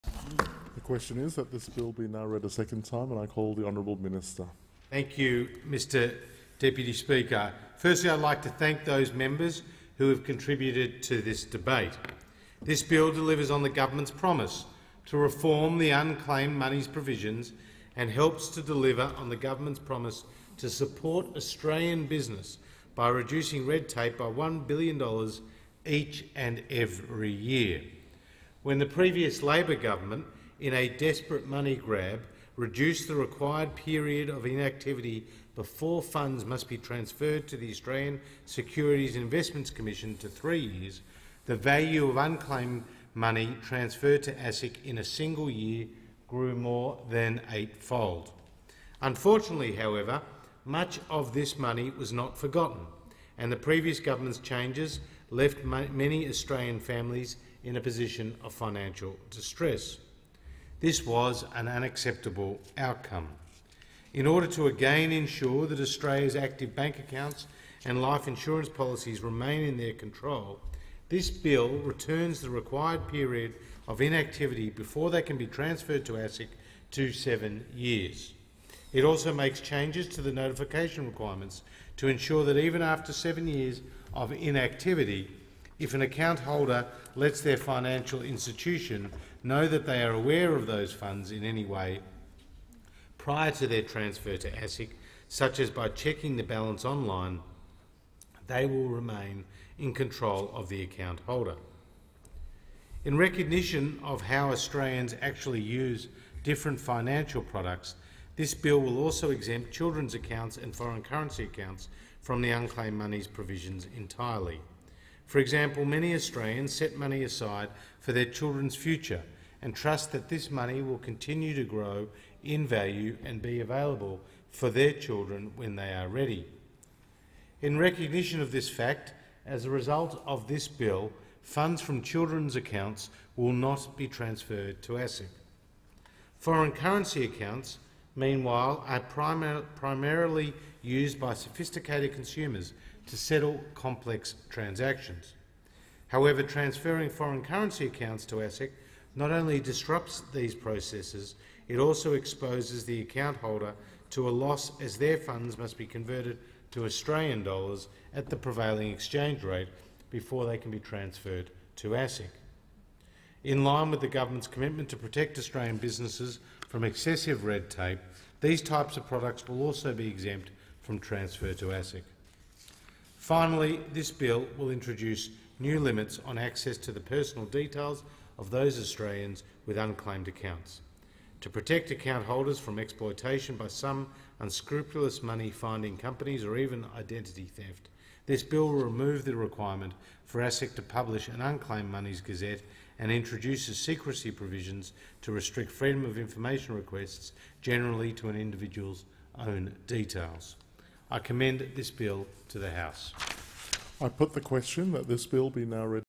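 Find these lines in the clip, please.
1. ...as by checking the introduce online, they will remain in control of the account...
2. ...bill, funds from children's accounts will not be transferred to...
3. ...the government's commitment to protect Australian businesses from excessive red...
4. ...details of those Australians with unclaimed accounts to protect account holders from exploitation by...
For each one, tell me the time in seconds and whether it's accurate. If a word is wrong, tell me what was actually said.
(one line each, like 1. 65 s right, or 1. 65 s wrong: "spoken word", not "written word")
1. 95 s wrong: "balance", not "introduce"
2. 130 s right
3. 164 s right
4. 177 s right.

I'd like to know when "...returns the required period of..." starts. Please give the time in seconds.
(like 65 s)
71 s.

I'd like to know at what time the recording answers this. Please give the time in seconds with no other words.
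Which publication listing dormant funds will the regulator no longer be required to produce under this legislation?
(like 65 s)
191 s.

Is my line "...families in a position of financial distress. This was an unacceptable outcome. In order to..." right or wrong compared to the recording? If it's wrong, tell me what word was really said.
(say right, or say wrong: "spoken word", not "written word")
right.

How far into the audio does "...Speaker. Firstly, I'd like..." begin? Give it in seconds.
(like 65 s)
6 s.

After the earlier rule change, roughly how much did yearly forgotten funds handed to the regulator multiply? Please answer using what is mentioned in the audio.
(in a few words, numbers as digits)
eightfold.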